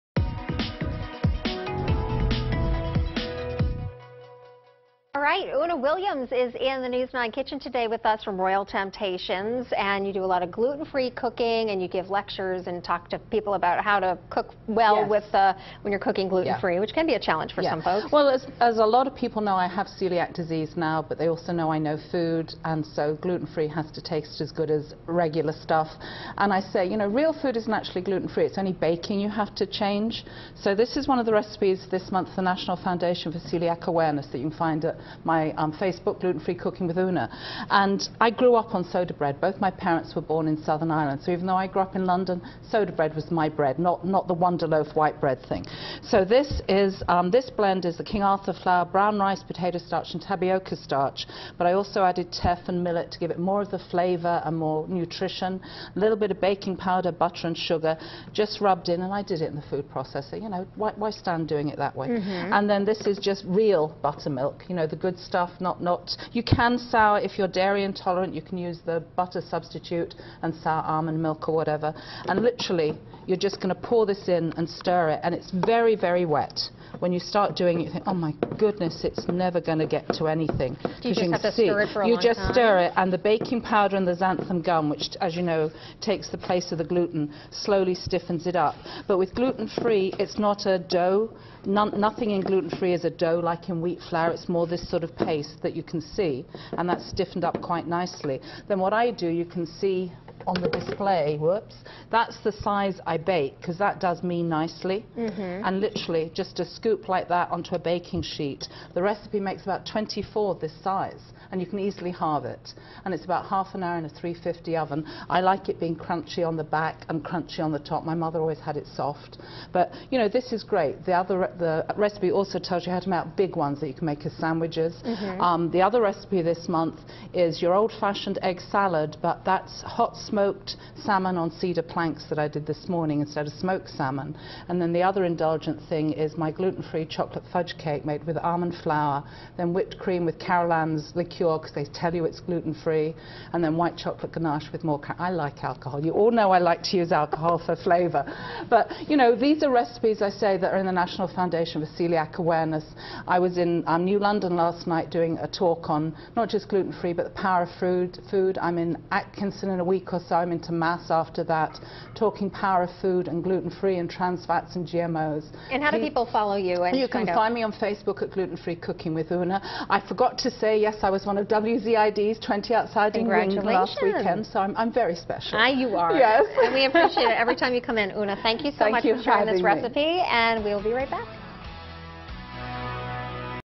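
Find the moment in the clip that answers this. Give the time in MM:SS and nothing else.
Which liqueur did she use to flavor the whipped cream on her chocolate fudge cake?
02:20.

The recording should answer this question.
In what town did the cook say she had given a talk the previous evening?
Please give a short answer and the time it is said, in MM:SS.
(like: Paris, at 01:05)
New London, at 02:34.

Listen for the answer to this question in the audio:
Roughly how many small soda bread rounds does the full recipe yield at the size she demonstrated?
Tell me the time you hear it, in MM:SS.
01:49.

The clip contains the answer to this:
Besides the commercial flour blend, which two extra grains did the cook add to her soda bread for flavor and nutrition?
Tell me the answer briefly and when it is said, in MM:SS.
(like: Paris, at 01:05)
teff and millet, at 00:52.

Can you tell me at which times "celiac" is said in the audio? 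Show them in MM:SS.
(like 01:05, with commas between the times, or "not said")
00:19, 00:33, 02:32.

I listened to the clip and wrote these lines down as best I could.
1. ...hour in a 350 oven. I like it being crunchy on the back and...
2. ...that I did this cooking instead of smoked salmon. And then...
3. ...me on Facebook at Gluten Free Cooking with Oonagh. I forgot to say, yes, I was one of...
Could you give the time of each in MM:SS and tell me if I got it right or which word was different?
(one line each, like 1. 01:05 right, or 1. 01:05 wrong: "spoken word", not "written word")
1. 01:53 right
2. 02:12 wrong: "morning", not "cooking"
3. 02:47 right.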